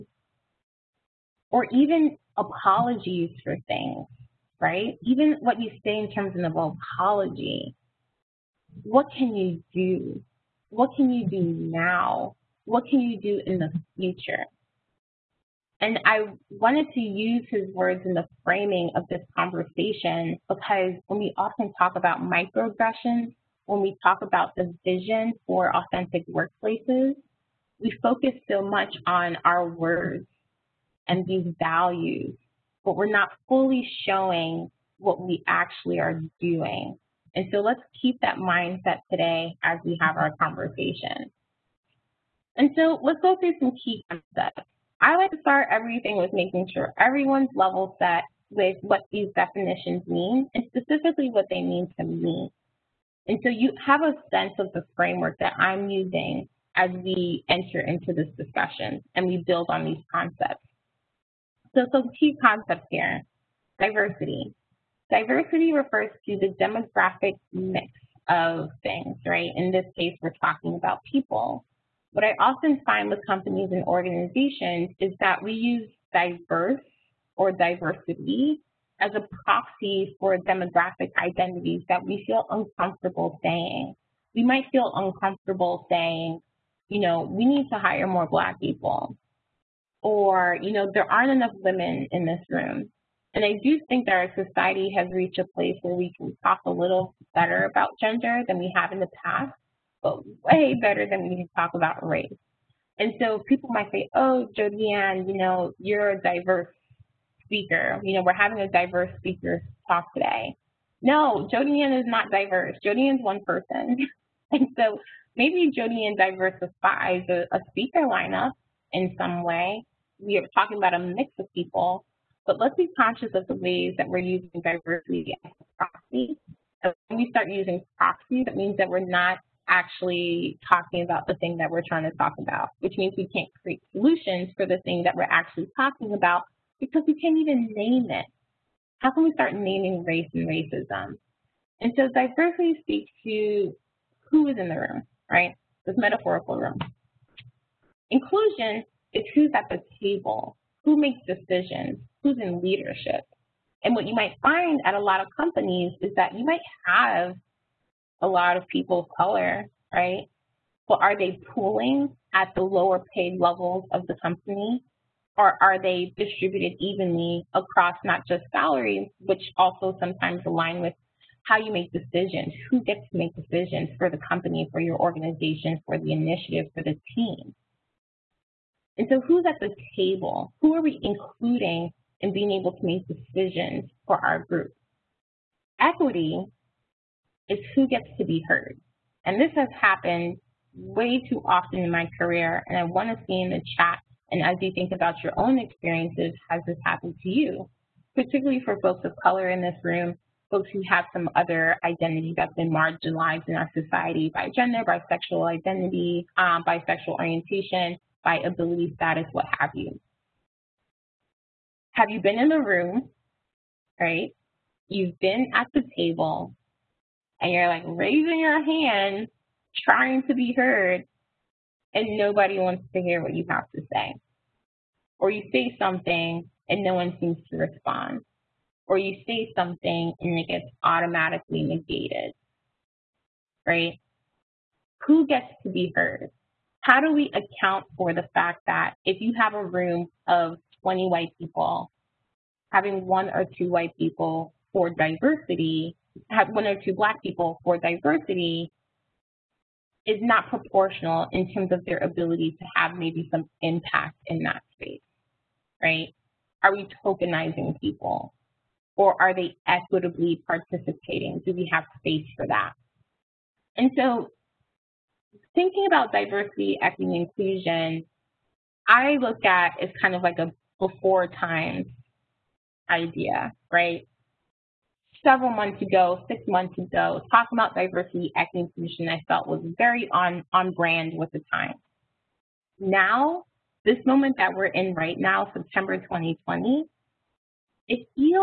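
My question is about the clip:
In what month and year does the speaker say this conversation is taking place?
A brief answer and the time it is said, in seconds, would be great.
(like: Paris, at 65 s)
September 2020, at 285 s.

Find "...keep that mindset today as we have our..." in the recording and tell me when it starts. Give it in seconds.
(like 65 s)
38 s.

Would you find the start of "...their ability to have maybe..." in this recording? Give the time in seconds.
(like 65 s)
251 s.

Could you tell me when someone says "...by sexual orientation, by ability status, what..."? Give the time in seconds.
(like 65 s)
206 s.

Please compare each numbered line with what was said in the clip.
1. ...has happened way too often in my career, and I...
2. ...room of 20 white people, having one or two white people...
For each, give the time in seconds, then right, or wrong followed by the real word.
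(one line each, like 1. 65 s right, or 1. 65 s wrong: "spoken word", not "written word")
1. 189 s right
2. 239 s right.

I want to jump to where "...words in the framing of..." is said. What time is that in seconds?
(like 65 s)
17 s.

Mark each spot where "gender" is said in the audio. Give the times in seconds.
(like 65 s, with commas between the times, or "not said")
97 s, 204 s.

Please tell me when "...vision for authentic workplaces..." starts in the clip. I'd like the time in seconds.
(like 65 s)
24 s.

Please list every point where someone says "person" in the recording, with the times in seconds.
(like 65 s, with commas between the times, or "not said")
113 s.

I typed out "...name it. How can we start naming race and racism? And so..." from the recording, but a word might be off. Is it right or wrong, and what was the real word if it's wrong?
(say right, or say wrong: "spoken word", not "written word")
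right.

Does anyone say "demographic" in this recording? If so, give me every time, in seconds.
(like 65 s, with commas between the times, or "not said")
66 s, 80 s.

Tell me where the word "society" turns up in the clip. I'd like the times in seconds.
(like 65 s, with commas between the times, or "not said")
94 s, 203 s.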